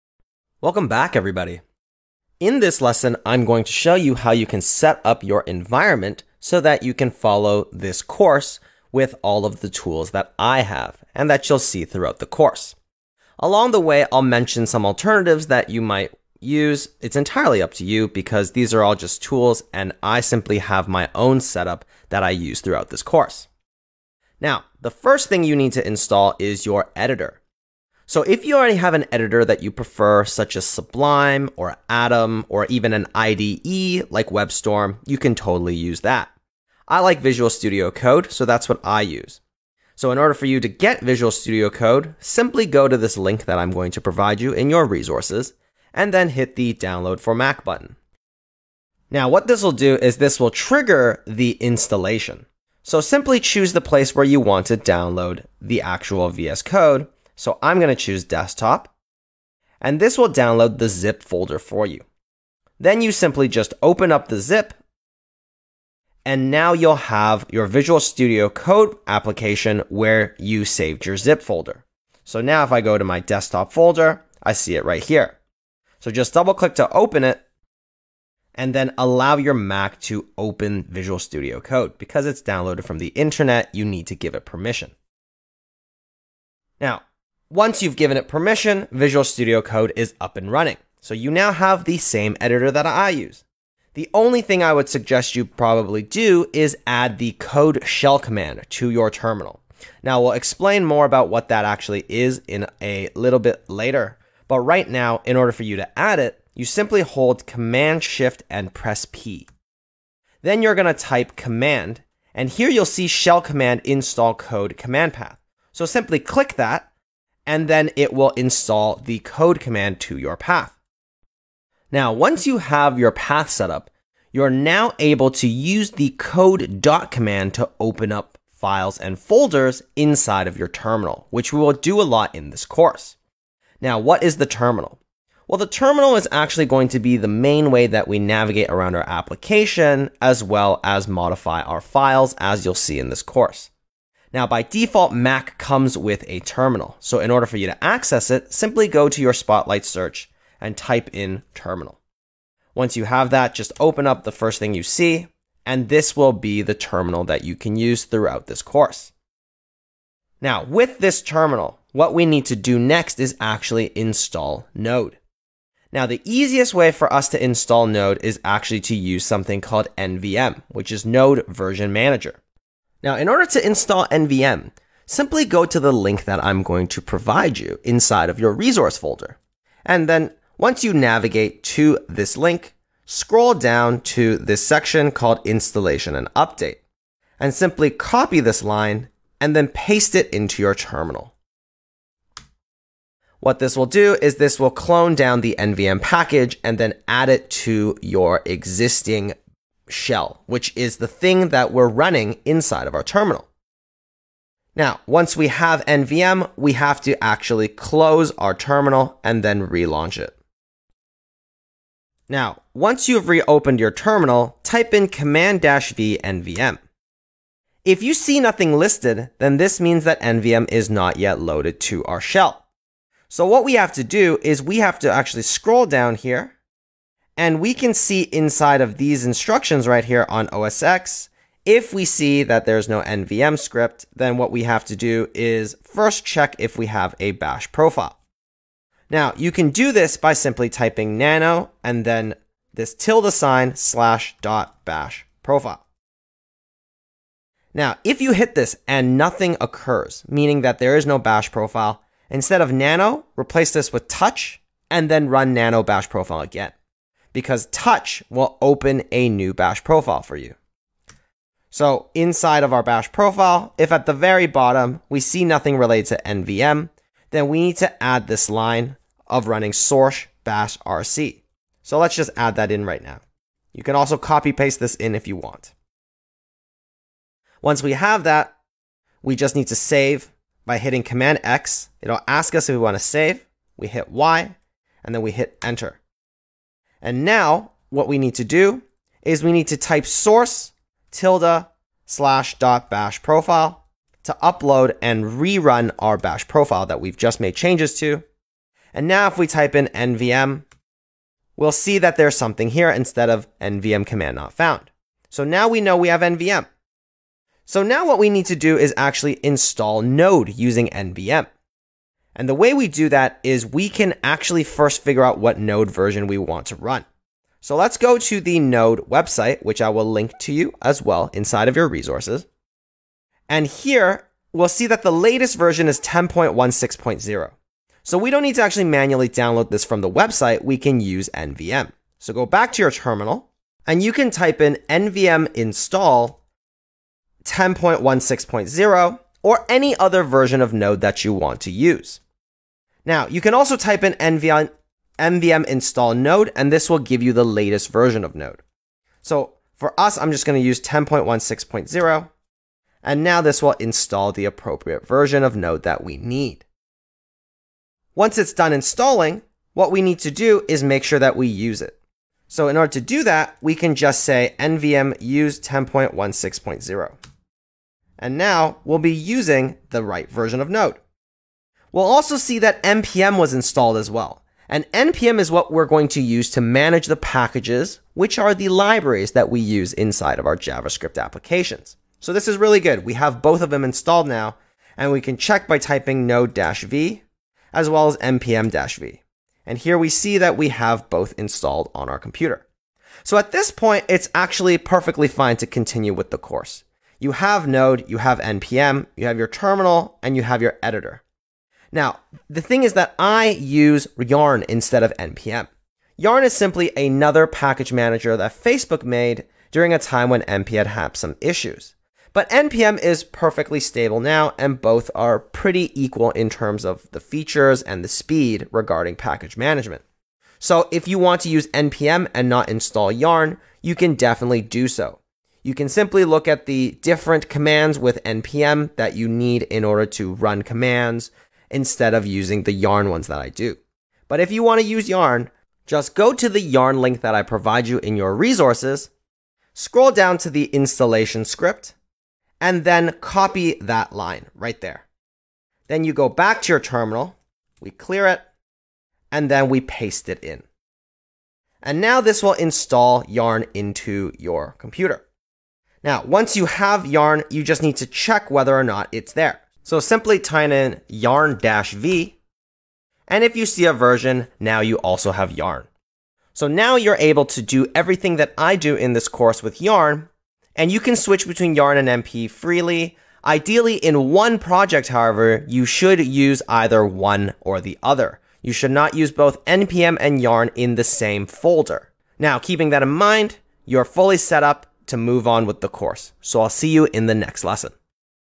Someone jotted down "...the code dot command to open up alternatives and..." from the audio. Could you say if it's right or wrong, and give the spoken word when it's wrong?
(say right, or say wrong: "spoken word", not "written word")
wrong: "files", not "alternatives".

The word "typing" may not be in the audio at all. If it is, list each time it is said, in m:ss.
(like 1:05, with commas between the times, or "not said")
4:00, 6:25.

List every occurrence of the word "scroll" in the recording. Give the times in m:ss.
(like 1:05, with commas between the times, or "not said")
3:03, 3:45, 7:19.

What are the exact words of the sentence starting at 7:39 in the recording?
So simply type in yarn-v, and if you see a version, now you also have yarn.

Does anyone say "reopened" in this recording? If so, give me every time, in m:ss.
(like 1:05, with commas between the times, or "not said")
3:33.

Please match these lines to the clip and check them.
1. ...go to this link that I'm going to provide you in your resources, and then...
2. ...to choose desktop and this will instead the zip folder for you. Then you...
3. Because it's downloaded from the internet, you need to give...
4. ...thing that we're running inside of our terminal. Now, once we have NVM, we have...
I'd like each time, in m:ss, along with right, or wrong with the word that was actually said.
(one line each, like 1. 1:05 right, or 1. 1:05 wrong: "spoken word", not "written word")
1. 0:42 right
2. 0:57 wrong: "download", not "instead"
3. 1:21 right
4. 3:21 right.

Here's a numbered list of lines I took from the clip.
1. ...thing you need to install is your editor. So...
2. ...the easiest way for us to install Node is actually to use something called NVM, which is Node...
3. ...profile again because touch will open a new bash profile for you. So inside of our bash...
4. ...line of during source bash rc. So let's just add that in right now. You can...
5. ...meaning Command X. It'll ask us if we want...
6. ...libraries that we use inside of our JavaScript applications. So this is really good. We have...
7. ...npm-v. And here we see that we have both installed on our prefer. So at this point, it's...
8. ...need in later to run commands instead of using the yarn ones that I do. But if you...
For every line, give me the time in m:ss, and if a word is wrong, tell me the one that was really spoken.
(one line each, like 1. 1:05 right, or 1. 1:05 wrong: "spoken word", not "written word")
1. 0:25 right
2. 2:46 right
3. 4:16 right
4. 4:28 wrong: "running", not "during"
5. 4:40 wrong: "hitting", not "meaning"
6. 6:18 right
7. 6:28 wrong: "computer", not "prefer"
8. 7:09 wrong: "order", not "later".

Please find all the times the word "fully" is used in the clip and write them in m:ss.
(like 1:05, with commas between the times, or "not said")
8:04.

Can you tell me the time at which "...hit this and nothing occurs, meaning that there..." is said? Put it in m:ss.
4:08.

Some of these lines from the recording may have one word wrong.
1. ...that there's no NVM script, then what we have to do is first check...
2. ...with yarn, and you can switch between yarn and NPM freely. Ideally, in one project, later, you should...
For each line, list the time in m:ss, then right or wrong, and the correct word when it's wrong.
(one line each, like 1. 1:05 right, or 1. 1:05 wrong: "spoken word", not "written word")
1. 3:52 right
2. 7:49 wrong: "however", not "later".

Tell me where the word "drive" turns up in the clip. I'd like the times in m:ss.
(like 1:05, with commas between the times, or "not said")
not said.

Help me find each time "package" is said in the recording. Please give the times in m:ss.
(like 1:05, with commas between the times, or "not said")
3:15, 6:17, 6:47, 6:59.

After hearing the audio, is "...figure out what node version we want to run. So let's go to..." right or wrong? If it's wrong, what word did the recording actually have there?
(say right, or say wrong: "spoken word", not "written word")
right.